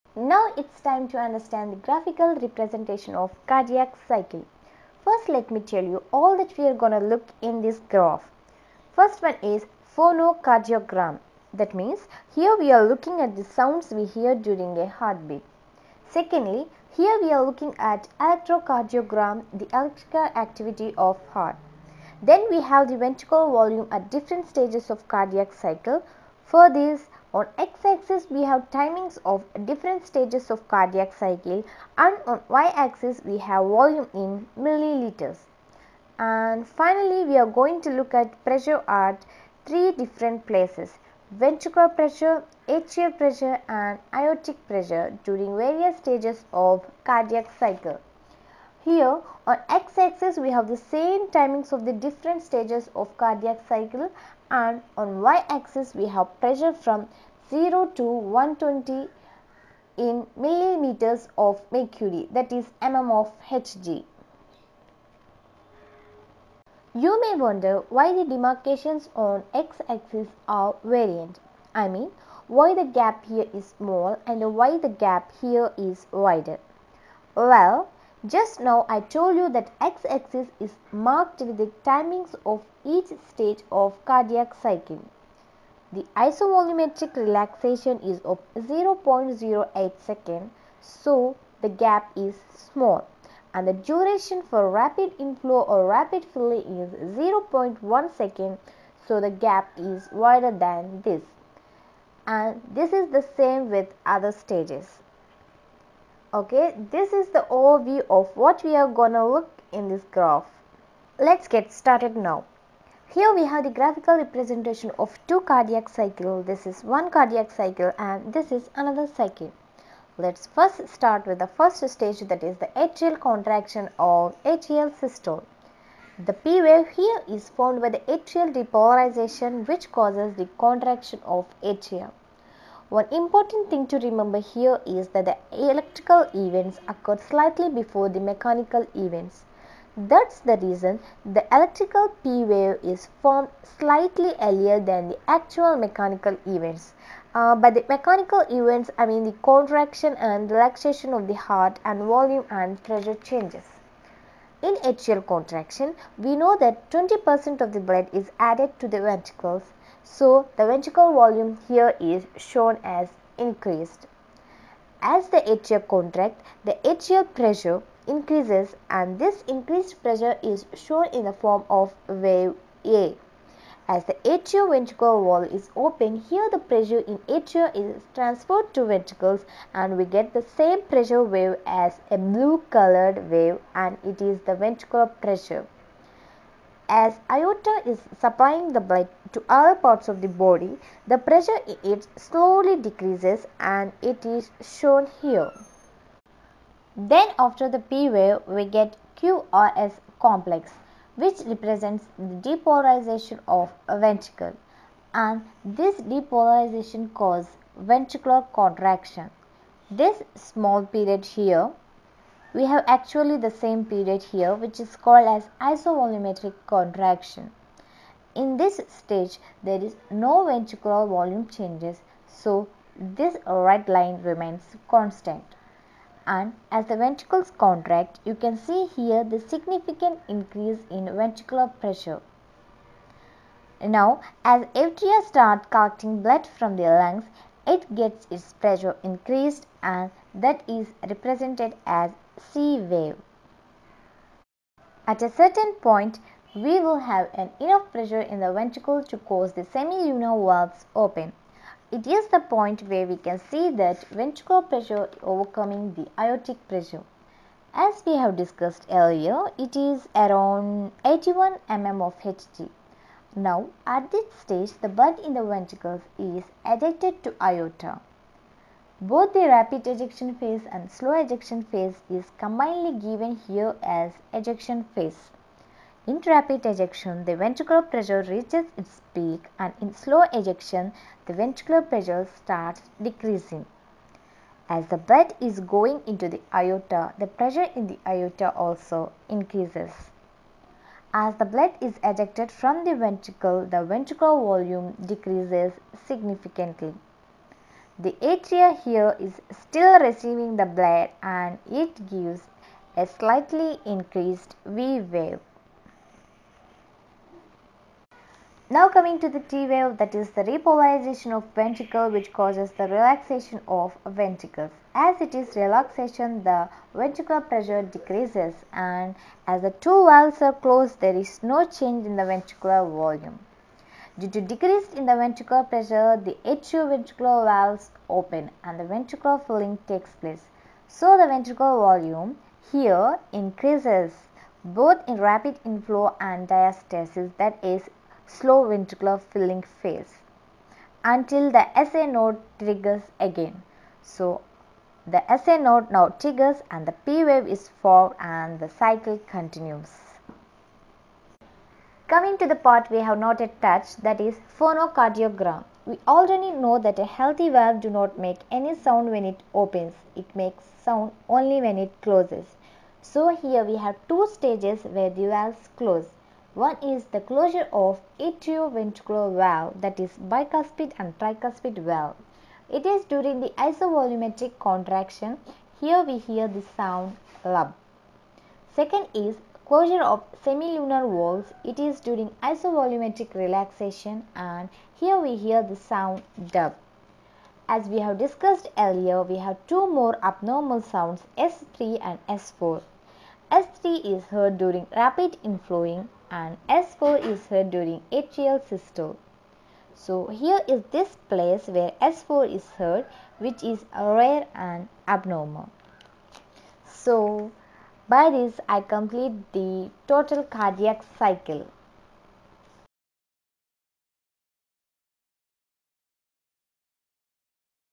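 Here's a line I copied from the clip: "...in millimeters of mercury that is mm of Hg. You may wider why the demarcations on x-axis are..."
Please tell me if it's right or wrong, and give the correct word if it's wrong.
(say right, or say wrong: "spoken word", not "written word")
wrong: "wonder", not "wider".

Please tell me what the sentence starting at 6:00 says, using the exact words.
It makes sound only when it closes.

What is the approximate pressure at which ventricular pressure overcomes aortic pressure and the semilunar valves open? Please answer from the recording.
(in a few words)
81 mm of Hg.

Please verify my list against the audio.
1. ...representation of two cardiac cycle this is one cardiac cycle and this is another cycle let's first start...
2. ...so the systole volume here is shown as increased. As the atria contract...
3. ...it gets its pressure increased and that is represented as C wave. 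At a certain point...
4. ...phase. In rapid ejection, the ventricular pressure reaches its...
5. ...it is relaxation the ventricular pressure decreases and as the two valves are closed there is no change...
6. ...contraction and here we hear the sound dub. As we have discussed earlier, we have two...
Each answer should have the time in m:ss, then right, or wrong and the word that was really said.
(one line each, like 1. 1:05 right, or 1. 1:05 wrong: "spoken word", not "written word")
1. 1:54 right
2. 2:40 wrong: "ventricle", not "systole"
3. 3:57 right
4. 4:34 right
5. 5:15 right
6. 6:23 wrong: "relaxation", not "contraction".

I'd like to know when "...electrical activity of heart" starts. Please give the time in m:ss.
0:19.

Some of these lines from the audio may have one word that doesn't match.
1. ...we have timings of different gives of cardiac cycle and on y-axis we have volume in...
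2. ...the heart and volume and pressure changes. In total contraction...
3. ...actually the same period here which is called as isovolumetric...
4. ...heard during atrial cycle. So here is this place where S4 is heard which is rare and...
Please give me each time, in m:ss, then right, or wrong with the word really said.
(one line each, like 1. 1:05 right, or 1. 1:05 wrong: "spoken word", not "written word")
1. 0:28 wrong: "stages", not "gives"
2. 2:31 wrong: "atrial", not "total"
3. 3:32 right
4. 6:37 wrong: "systole", not "cycle".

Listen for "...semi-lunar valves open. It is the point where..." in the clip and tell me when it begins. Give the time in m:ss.
4:09.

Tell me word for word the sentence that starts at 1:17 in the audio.
Well, just now I told you that x-axis is marked with the timings of each stage of cardiac cycle.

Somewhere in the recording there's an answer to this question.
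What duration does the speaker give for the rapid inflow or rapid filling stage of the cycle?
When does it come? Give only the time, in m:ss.
1:36.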